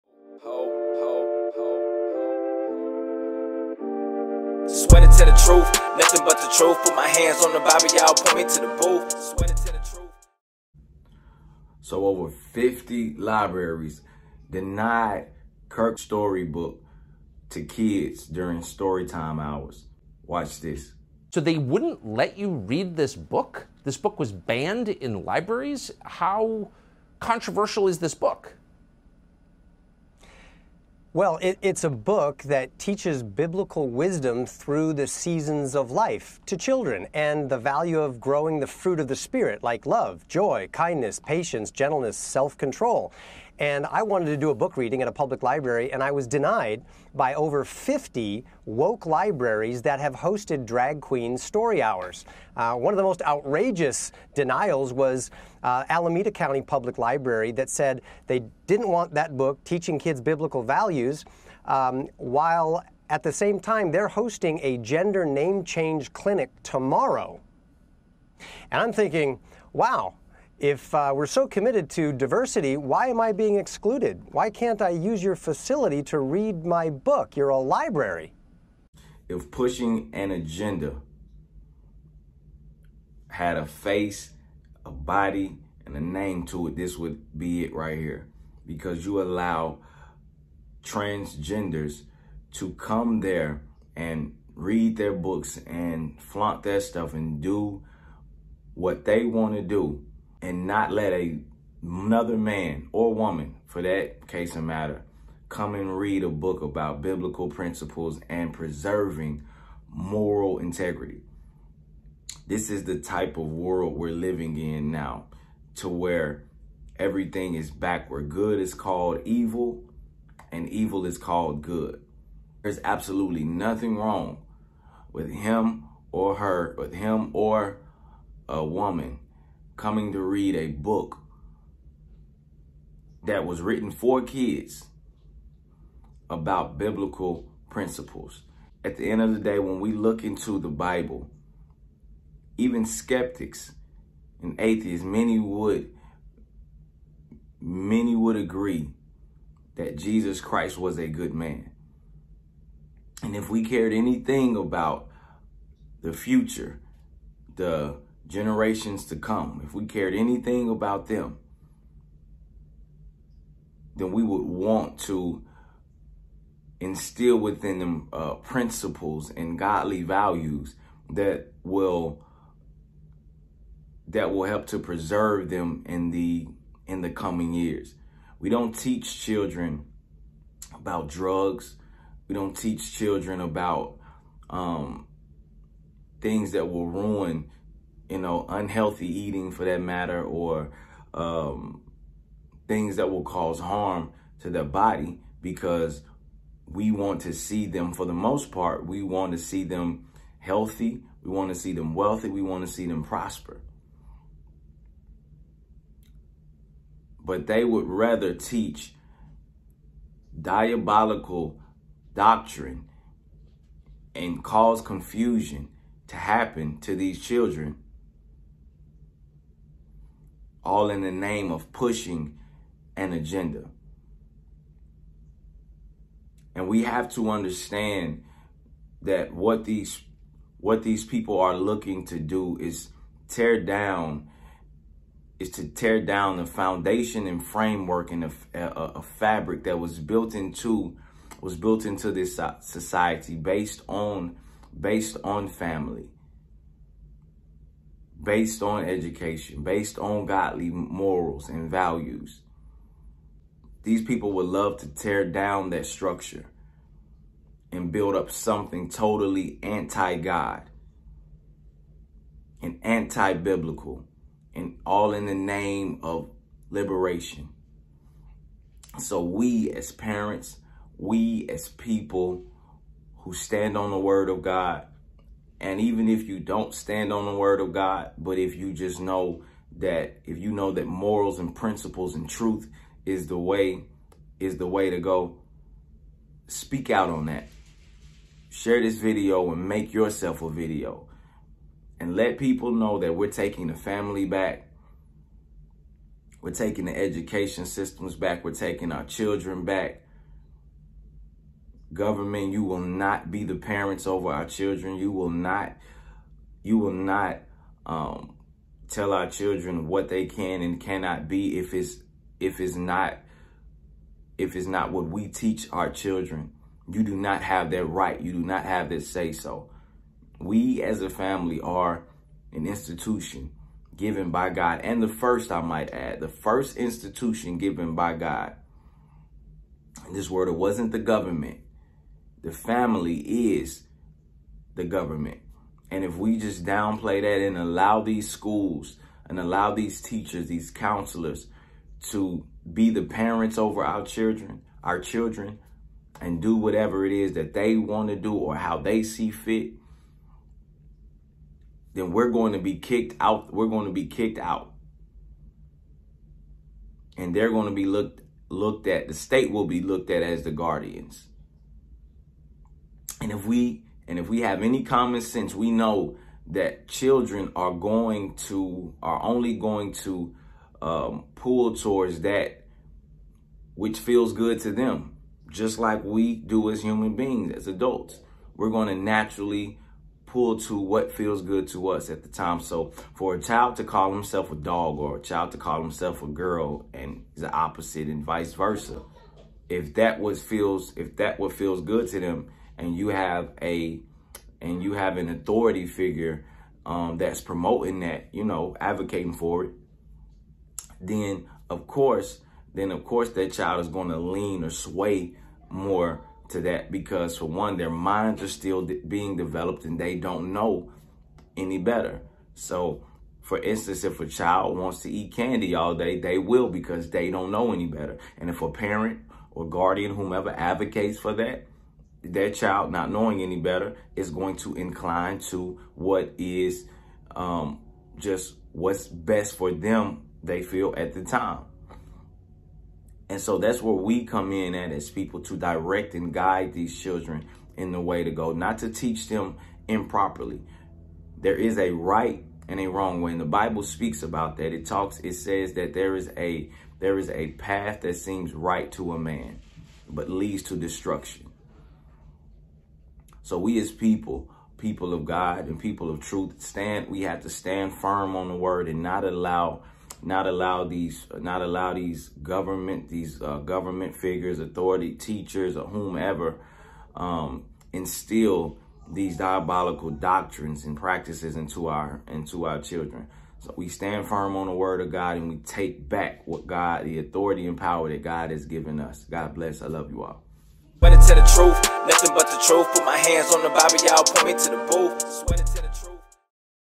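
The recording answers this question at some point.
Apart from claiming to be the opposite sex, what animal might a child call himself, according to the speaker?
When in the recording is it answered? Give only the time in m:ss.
6:24.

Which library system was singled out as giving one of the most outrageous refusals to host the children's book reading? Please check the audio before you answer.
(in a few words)
Alameda County Public Library.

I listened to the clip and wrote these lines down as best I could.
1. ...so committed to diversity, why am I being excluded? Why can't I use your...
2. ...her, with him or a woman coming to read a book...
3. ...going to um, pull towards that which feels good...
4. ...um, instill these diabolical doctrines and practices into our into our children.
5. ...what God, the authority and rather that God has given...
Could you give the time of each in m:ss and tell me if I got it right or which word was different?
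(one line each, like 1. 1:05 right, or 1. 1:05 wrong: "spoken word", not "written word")
1. 1:11 right
2. 2:06 right
3. 6:09 right
4. 7:47 right
5. 7:56 wrong: "power", not "rather".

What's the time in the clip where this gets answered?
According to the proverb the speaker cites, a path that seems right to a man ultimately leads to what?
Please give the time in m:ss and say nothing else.
7:30.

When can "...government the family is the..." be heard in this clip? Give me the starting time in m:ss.
5:30.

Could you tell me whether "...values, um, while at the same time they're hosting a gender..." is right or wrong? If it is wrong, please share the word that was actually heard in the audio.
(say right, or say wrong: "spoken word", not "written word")
right.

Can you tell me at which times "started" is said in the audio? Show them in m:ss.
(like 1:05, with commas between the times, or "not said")
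not said.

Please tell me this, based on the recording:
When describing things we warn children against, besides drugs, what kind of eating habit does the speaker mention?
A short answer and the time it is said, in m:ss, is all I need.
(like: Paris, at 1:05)
unhealthy eating, at 3:08.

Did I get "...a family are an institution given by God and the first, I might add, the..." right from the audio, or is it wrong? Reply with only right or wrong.
right.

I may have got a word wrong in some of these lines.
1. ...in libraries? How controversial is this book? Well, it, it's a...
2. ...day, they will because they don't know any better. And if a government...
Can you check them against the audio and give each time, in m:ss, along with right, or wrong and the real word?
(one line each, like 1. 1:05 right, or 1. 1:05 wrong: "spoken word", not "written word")
1. 0:24 right
2. 6:55 wrong: "parent", not "government".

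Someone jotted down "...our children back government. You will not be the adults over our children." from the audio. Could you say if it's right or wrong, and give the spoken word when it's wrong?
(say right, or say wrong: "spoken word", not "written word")
wrong: "parents", not "adults".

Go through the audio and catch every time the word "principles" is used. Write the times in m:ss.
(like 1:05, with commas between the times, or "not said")
1:47, 2:17, 2:48, 4:41.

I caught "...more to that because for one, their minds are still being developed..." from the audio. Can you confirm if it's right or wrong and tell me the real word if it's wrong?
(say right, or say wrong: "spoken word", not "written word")
right.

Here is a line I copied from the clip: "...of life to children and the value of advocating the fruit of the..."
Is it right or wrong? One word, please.
wrong.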